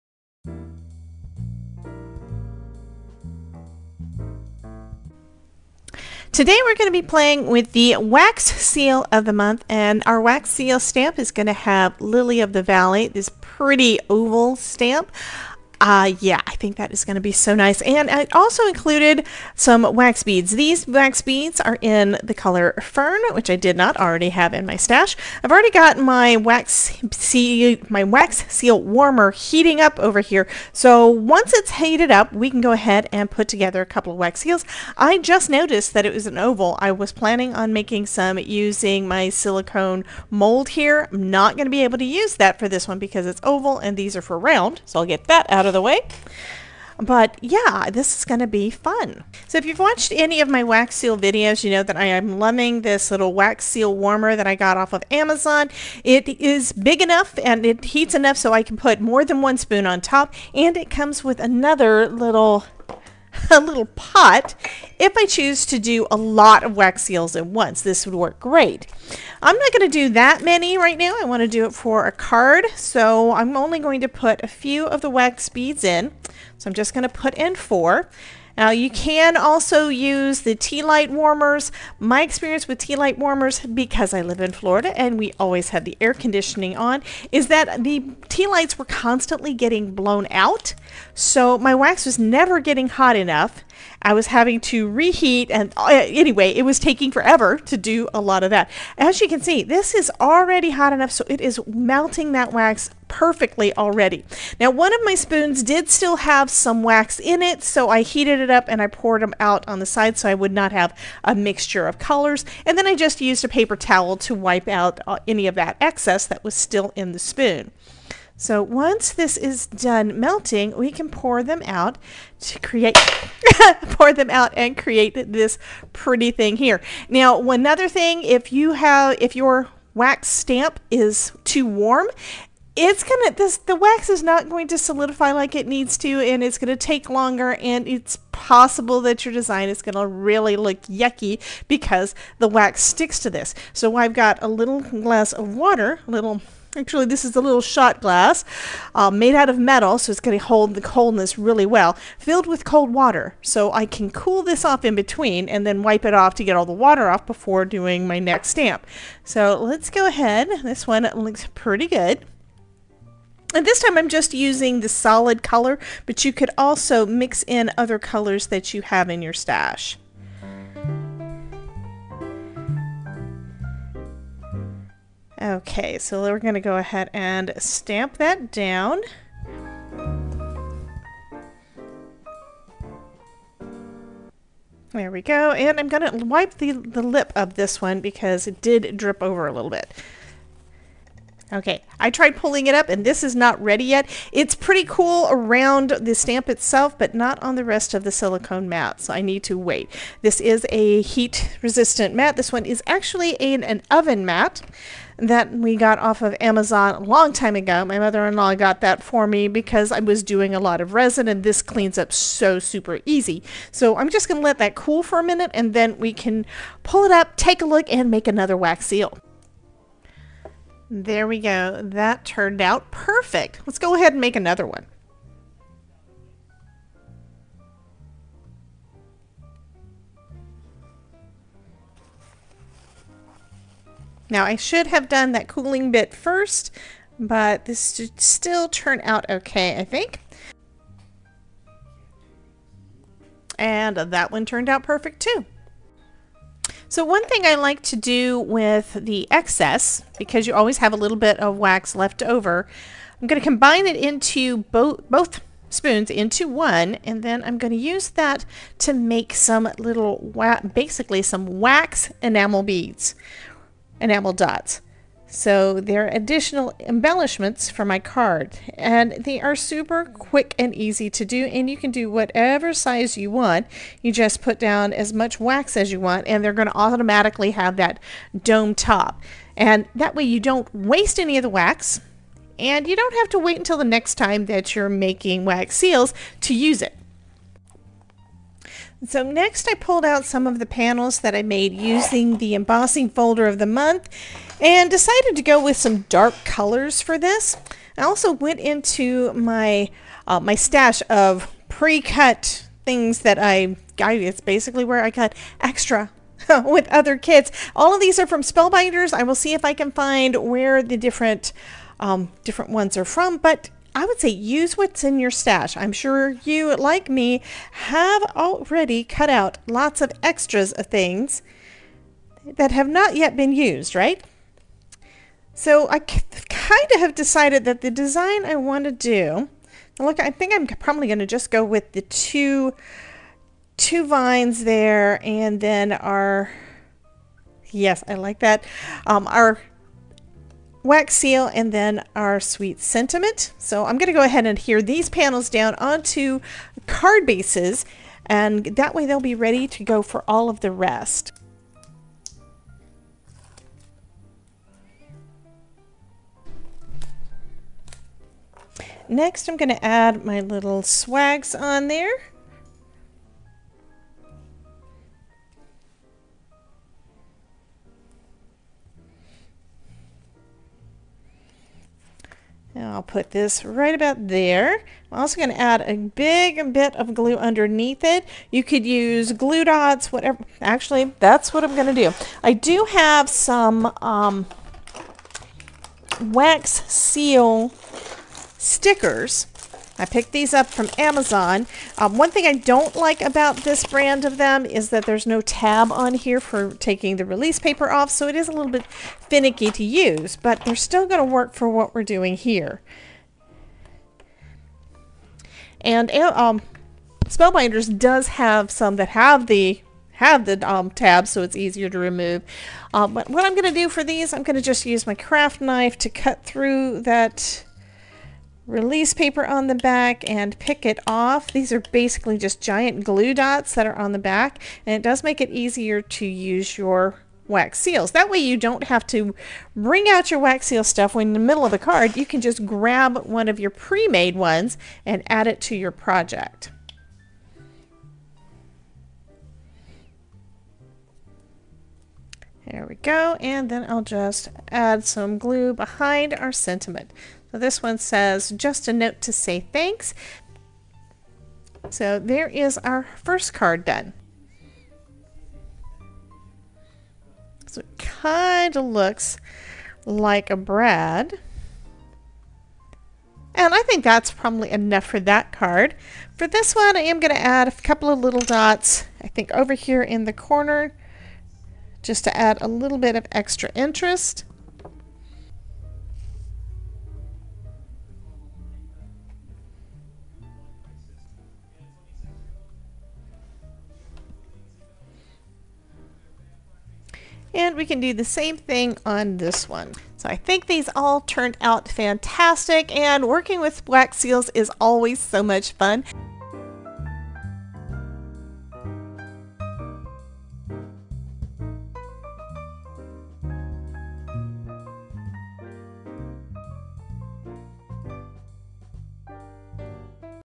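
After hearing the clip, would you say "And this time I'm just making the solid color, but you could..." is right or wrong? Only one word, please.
wrong.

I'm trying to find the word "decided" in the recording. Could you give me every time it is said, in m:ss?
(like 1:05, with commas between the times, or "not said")
4:54, 5:27.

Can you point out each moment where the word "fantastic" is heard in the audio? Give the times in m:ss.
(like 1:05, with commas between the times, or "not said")
8:11.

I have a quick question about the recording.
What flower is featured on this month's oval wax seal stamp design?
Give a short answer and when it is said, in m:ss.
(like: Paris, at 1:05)
Lily of the Valley, at 0:12.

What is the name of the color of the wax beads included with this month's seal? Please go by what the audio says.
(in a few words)
Fern.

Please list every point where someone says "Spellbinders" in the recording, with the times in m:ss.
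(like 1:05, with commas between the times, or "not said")
5:08, 6:47.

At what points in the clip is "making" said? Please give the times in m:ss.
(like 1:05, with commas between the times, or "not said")
0:37, 4:44.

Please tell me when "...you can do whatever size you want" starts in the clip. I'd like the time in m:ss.
4:31.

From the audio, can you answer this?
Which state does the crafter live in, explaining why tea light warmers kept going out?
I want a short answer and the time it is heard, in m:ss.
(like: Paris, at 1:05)
Florida, at 1:24.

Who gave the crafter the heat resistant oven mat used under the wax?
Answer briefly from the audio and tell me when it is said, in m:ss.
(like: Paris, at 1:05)
Mother in law, at 3:27.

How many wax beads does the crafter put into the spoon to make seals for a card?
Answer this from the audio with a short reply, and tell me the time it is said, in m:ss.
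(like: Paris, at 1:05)
4, at 1:17.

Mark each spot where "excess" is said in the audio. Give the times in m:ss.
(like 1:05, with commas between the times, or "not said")
1:55, 4:09.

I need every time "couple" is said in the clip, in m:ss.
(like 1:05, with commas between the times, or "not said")
0:33, 7:47.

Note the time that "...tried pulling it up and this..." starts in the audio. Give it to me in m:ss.
3:12.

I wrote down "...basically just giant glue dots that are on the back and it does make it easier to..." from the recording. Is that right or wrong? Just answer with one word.
right.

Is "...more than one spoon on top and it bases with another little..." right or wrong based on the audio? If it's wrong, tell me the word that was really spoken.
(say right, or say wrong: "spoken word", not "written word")
wrong: "comes", not "bases".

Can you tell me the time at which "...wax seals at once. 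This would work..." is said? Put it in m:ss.
1:06.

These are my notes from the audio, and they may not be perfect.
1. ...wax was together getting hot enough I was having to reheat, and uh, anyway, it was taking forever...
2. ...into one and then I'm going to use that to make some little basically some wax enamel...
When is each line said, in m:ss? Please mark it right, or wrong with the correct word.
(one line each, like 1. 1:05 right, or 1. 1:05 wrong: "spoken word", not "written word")
1. 1:31 wrong: "never", not "together"
2. 4:16 right.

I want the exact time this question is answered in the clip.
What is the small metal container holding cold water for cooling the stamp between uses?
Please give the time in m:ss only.
2:27.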